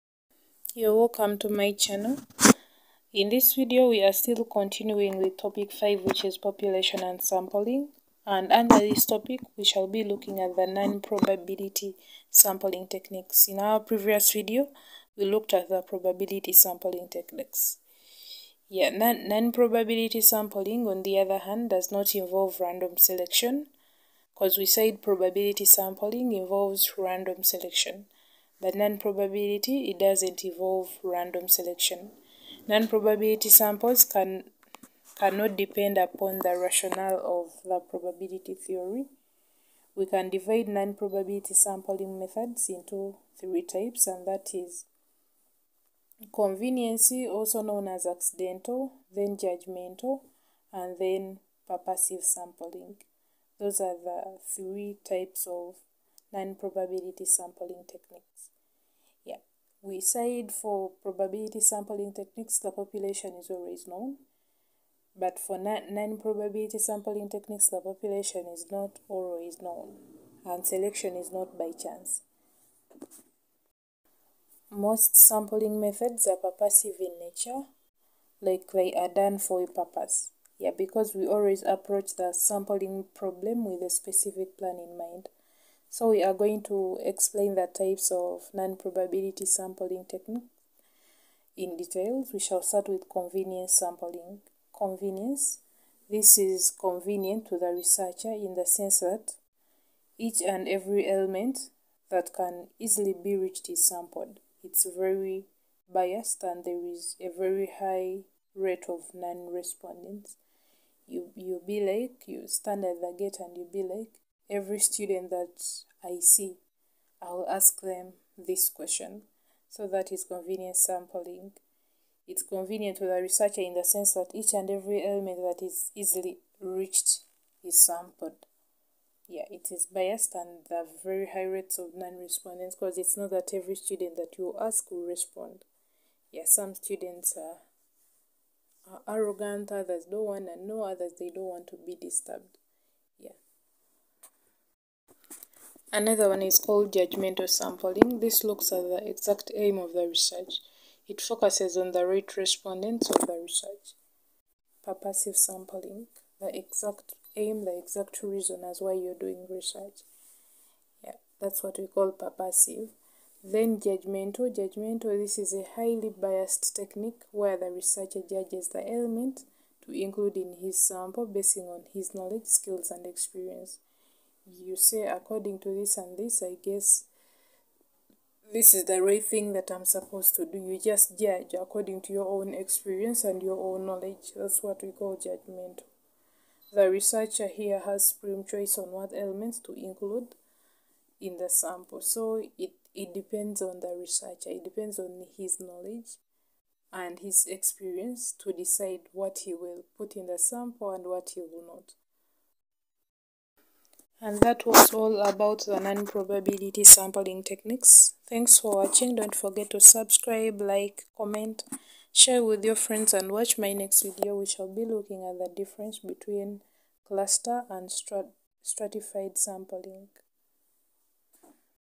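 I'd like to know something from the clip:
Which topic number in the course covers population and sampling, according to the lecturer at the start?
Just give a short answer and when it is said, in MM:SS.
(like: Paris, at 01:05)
5, at 00:05.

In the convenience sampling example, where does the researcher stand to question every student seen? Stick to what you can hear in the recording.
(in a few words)
At the gate.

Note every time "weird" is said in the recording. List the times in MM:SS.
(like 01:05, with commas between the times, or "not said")
not said.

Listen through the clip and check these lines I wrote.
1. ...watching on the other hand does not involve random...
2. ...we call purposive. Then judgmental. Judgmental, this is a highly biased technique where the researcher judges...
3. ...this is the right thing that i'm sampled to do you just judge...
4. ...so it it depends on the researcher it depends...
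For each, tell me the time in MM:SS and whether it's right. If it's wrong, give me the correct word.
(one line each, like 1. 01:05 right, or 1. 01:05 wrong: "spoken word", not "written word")
1. 00:20 wrong: "sampling", not "watching"
2. 02:41 right
3. 02:58 wrong: "supposed", not "sampled"
4. 03:12 right.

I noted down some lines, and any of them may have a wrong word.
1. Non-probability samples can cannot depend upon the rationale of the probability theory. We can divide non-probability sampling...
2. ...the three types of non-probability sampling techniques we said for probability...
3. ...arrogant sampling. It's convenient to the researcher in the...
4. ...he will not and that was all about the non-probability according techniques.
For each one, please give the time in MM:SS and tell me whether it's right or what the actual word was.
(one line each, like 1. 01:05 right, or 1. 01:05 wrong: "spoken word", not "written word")
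1. 00:32 right
2. 00:53 right
3. 02:00 wrong: "convenient", not "arrogant"
4. 03:21 wrong: "sampling", not "according".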